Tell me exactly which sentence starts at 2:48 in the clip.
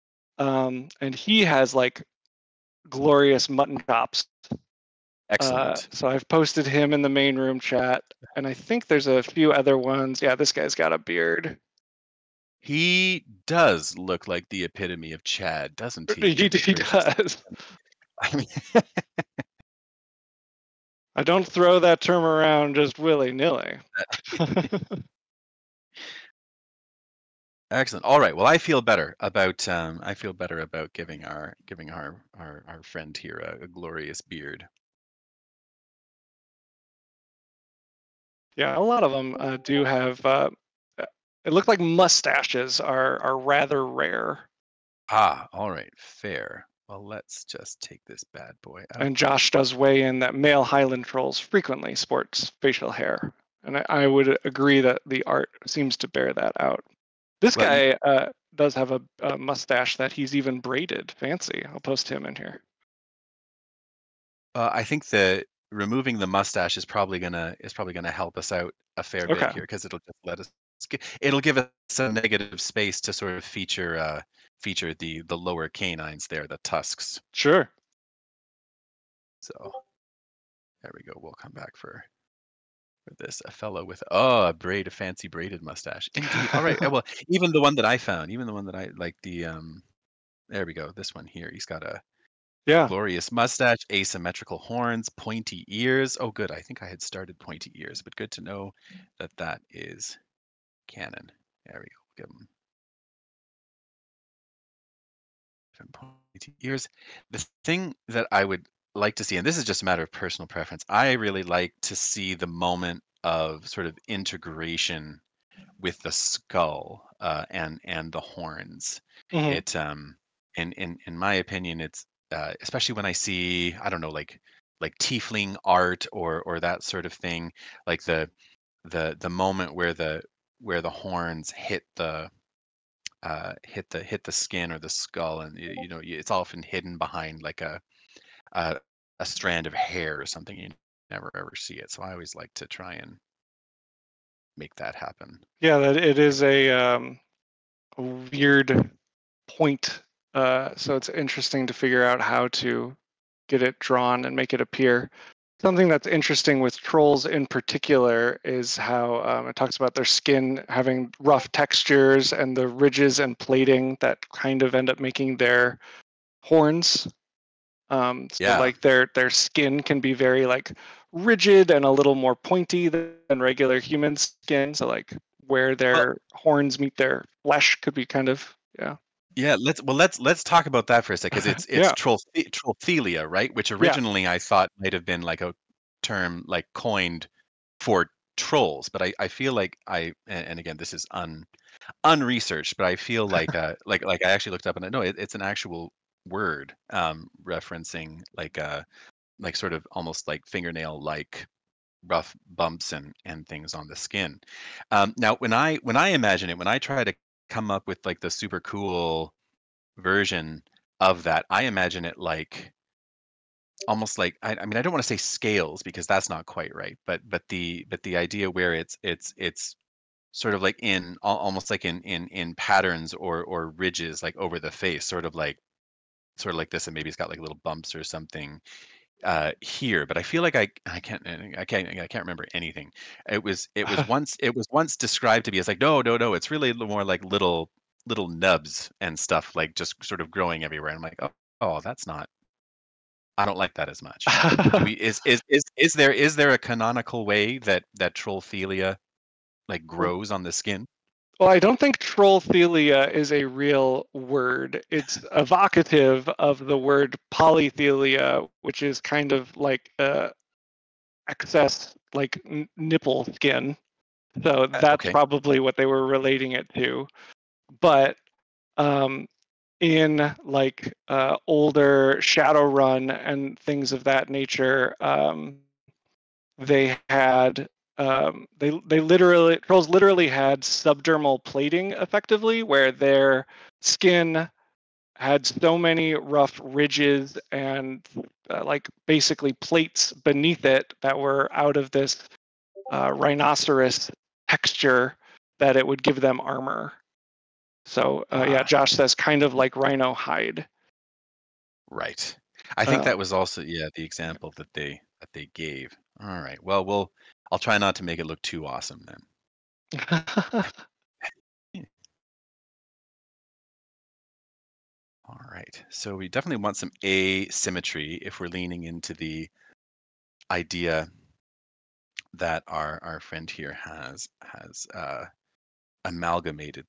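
like their their skin can be very like rigid and a little more pointy than regular human skin.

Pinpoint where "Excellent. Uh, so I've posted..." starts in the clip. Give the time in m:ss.
0:05.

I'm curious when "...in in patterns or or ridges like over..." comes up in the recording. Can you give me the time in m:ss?
3:42.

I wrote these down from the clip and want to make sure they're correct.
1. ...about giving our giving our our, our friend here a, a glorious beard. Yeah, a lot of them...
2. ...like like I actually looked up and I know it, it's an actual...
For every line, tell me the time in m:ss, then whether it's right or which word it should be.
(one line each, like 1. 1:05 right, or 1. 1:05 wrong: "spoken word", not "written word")
1. 0:30 right
2. 3:13 right.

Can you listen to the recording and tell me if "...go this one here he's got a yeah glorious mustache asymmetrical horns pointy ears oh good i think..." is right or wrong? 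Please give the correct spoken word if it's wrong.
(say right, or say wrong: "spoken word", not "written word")
right.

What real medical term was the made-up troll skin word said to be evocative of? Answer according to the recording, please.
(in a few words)
Polythelia.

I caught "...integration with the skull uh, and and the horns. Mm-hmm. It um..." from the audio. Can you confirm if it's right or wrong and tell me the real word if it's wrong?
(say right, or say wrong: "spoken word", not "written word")
right.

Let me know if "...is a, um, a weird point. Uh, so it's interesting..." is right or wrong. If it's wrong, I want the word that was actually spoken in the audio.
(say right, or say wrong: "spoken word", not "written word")
right.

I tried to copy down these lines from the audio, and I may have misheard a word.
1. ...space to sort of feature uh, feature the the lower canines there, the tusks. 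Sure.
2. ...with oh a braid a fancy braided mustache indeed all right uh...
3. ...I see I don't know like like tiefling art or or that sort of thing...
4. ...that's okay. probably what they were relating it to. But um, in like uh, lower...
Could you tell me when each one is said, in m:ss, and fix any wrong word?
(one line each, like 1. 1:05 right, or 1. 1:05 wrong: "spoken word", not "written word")
1. 1:12 right
2. 1:23 right
3. 2:03 right
4. 4:24 wrong: "older", not "lower".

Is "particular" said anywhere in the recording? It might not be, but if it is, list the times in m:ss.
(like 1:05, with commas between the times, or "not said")
2:37.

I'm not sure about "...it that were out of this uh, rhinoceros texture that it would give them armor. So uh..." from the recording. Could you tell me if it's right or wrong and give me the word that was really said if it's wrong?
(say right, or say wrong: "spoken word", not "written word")
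right.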